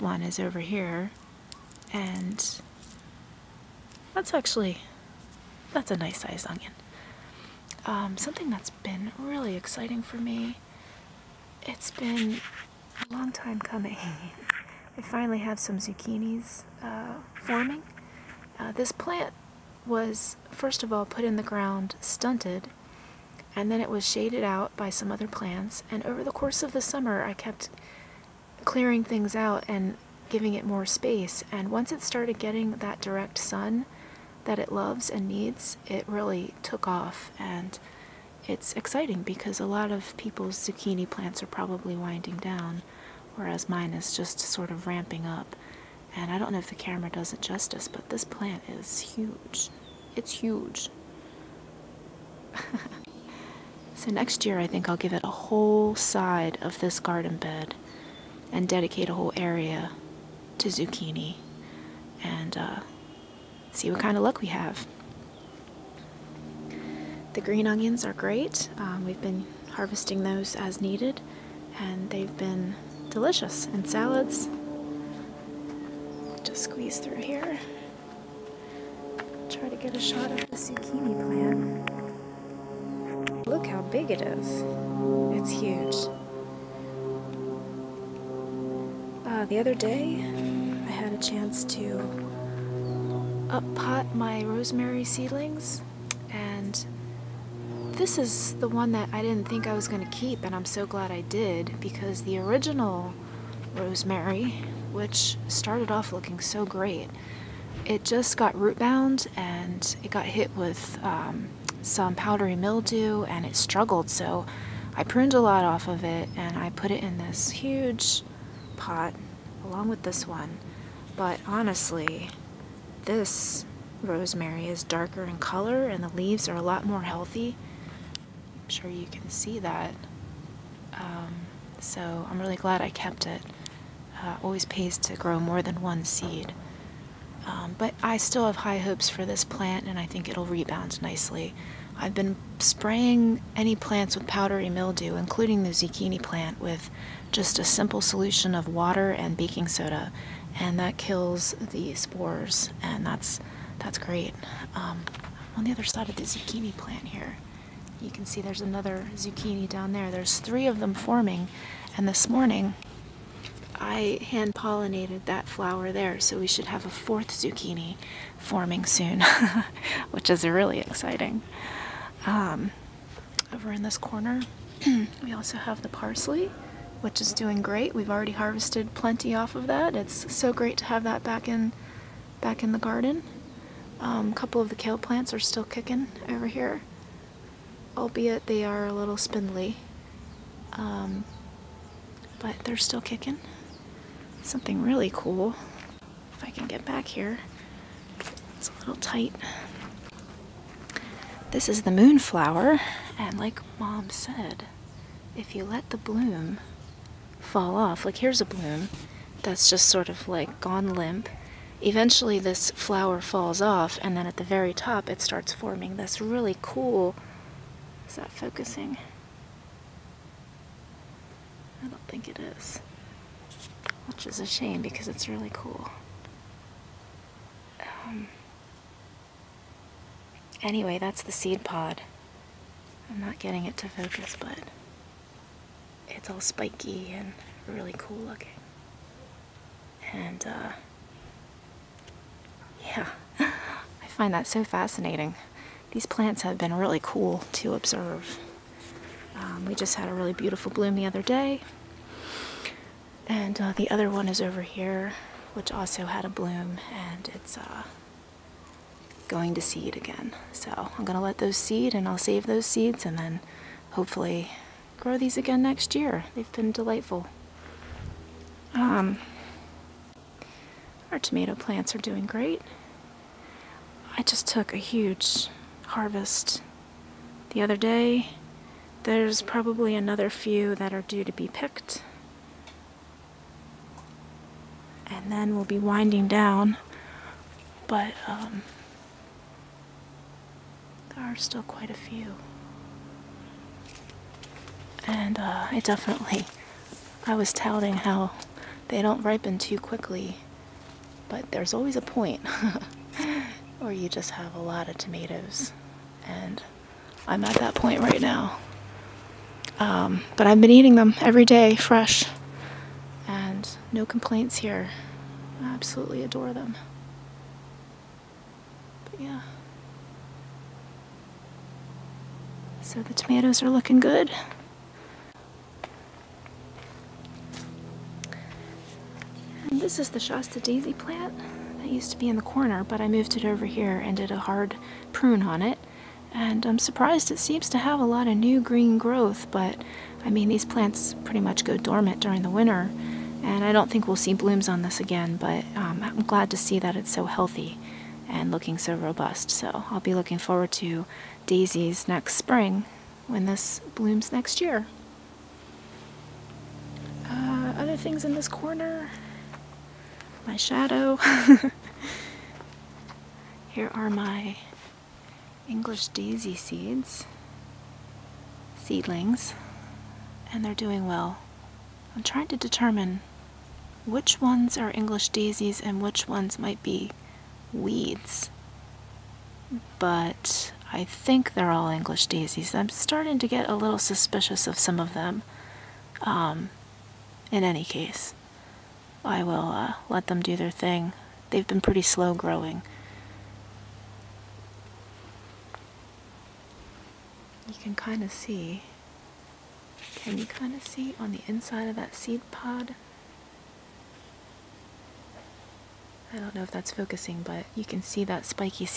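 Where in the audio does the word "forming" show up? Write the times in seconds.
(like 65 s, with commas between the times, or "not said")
17 s, 160 s, 168 s, 215 s.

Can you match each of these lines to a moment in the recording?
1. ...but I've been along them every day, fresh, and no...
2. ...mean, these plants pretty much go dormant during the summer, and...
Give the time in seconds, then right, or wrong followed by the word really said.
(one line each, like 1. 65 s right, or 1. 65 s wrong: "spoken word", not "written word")
1. 310 s wrong: "eating", not "along"
2. 340 s wrong: "winter", not "summer".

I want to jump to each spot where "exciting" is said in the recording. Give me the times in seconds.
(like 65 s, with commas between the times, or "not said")
9 s, 38 s, 170 s.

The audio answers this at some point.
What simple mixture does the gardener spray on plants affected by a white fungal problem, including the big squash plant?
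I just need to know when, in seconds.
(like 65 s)
148 s.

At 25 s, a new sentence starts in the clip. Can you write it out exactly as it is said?
And over the course of the summer, I kept clearing things out and giving it more space.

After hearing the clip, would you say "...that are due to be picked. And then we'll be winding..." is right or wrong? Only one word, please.
right.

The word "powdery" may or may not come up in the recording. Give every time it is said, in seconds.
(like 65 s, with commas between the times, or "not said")
112 s, 144 s.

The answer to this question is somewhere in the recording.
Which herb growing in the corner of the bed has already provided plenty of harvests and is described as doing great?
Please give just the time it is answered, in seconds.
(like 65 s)
175 s.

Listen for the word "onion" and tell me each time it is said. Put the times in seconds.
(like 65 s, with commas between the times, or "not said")
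6 s, 67 s.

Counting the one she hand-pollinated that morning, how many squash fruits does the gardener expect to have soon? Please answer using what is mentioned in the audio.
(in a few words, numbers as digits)
4.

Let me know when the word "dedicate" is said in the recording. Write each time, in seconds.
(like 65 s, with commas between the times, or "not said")
58 s.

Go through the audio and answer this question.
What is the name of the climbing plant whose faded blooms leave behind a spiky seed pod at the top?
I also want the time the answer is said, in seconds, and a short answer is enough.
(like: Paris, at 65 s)
Moonflower, at 201 s.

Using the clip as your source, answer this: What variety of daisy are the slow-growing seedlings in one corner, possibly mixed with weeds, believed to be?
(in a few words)
English daisy.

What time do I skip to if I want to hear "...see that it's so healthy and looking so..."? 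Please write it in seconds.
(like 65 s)
346 s.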